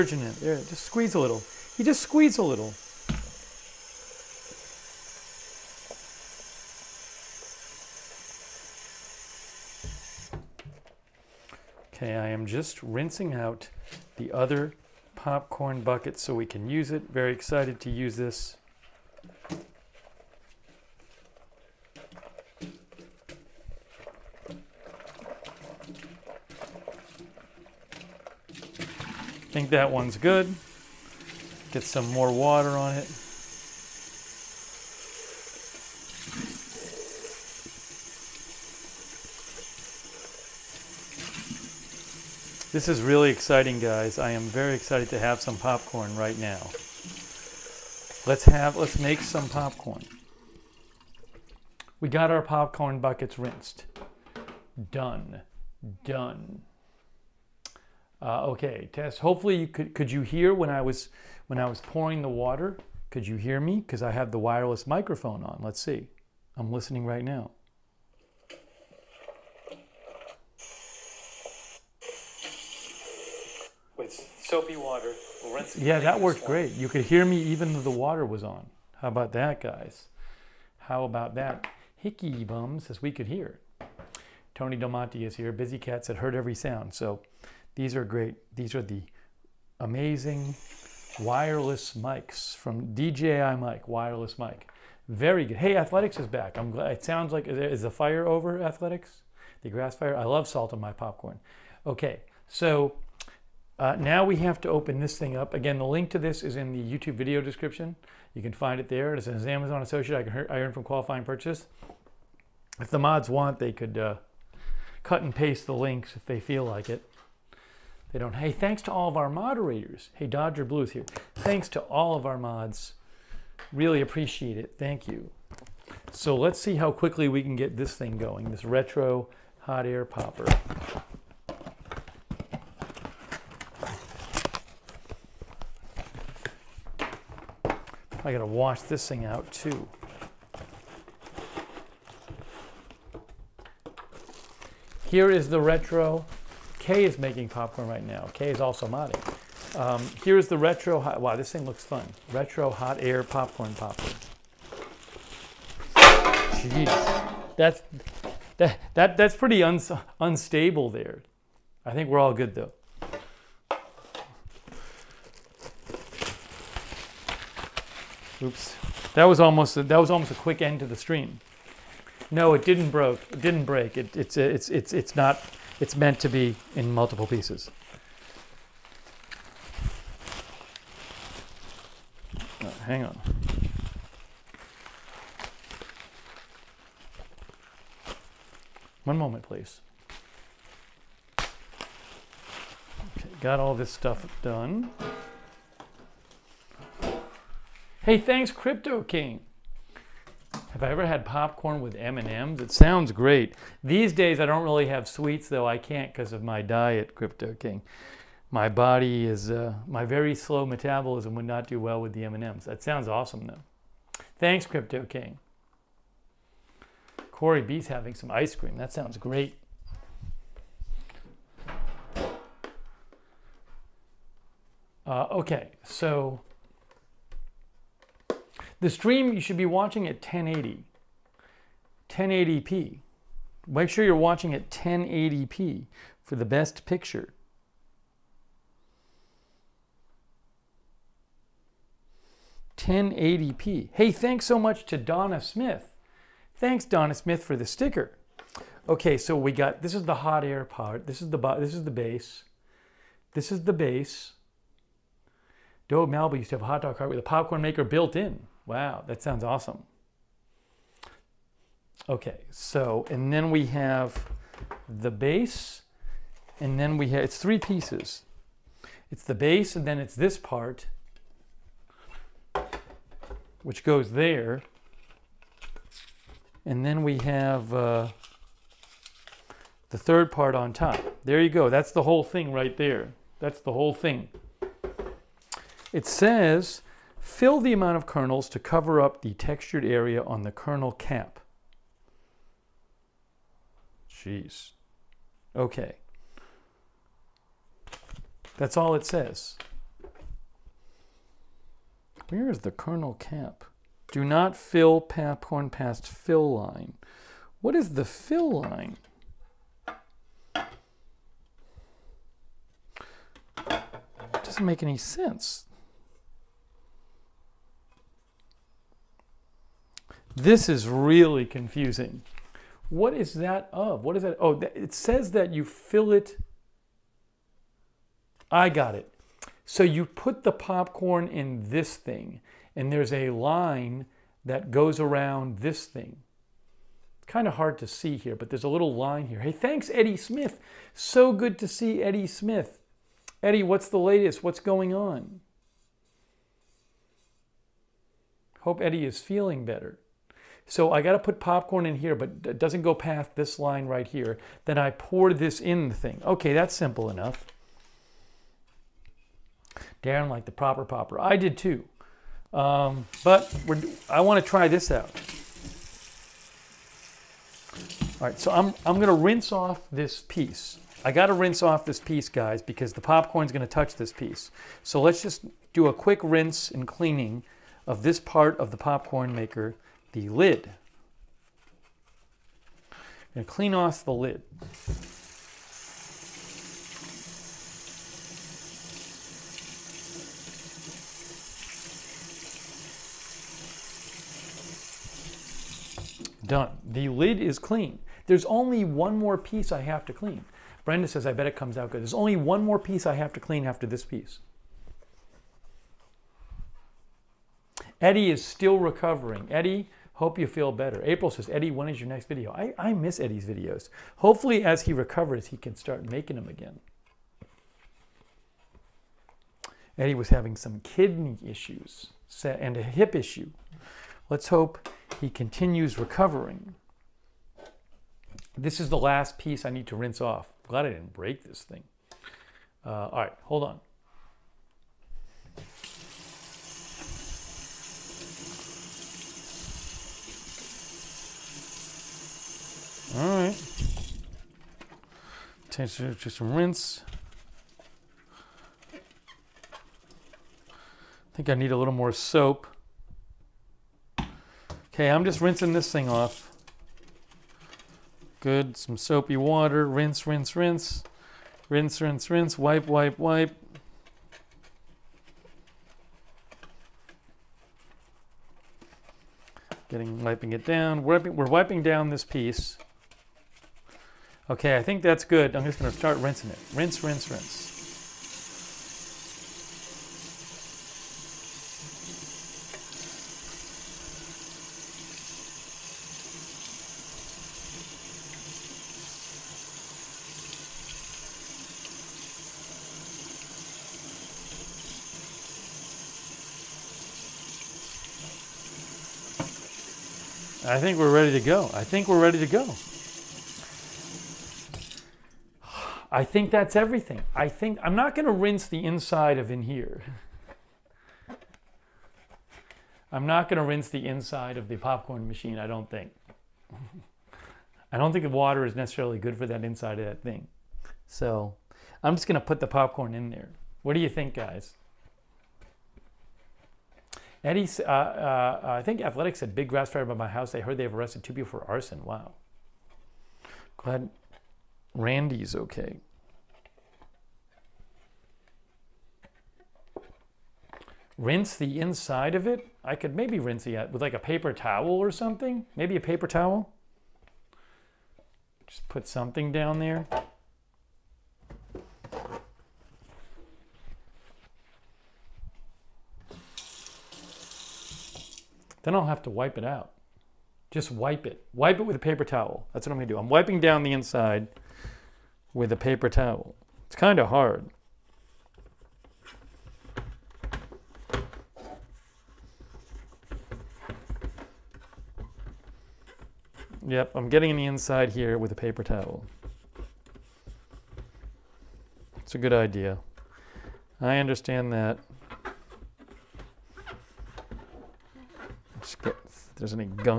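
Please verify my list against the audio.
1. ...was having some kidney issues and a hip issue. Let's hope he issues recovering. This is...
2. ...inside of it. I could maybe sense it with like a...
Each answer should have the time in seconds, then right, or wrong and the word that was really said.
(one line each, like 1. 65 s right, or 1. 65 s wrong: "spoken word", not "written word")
1. 420 s wrong: "continues", not "issues"
2. 541 s wrong: "rinse", not "sense".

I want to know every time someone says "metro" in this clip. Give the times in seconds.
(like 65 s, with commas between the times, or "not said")
not said.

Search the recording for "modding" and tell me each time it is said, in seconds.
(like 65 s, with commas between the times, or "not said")
148 s.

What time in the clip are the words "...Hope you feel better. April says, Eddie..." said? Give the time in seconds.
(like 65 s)
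410 s.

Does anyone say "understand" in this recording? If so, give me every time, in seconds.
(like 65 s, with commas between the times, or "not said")
584 s.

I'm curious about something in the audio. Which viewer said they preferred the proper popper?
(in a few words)
Darren.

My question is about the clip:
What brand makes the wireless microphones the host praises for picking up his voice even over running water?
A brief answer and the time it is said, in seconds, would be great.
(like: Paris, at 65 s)
DJI, at 92 s.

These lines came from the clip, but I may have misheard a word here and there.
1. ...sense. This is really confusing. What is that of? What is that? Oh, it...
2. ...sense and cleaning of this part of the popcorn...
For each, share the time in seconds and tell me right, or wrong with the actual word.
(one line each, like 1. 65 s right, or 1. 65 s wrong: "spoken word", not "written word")
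1. 314 s right
2. 376 s wrong: "rinse", not "sense".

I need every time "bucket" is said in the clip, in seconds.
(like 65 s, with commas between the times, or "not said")
15 s, 52 s.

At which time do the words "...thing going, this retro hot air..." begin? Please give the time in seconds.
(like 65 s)
127 s.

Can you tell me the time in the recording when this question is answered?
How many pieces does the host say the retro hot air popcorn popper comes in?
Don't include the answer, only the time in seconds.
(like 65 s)
267 s.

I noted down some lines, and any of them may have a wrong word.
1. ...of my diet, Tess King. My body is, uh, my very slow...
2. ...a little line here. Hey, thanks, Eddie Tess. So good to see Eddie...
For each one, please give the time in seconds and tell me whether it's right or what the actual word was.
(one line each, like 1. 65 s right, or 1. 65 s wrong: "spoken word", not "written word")
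1. 206 s wrong: "Crypto", not "Tess"
2. 338 s wrong: "Smith", not "Tess".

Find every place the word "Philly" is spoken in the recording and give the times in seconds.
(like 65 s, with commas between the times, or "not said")
not said.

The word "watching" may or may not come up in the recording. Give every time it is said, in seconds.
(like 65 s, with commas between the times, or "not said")
229 s, 234 s.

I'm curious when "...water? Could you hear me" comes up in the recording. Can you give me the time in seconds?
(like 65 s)
62 s.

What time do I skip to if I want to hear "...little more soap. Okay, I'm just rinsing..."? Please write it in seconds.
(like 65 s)
451 s.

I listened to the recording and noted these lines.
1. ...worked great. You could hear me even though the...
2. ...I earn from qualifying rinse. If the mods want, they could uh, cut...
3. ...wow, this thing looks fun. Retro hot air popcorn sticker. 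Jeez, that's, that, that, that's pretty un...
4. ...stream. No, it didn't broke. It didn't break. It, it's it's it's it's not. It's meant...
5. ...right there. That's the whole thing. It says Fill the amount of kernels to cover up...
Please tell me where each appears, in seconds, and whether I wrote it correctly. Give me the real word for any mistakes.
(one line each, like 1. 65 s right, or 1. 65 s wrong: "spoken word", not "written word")
1. 76 s right
2. 110 s wrong: "purchase", not "rinse"
3. 151 s wrong: "popper", not "sticker"
4. 170 s right
5. 282 s right.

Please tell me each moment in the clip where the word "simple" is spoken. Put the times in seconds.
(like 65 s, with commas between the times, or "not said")
356 s.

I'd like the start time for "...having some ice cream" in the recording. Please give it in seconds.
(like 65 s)
217 s.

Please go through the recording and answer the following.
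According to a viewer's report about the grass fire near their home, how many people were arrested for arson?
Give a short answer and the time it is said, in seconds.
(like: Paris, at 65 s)
2, at 531 s.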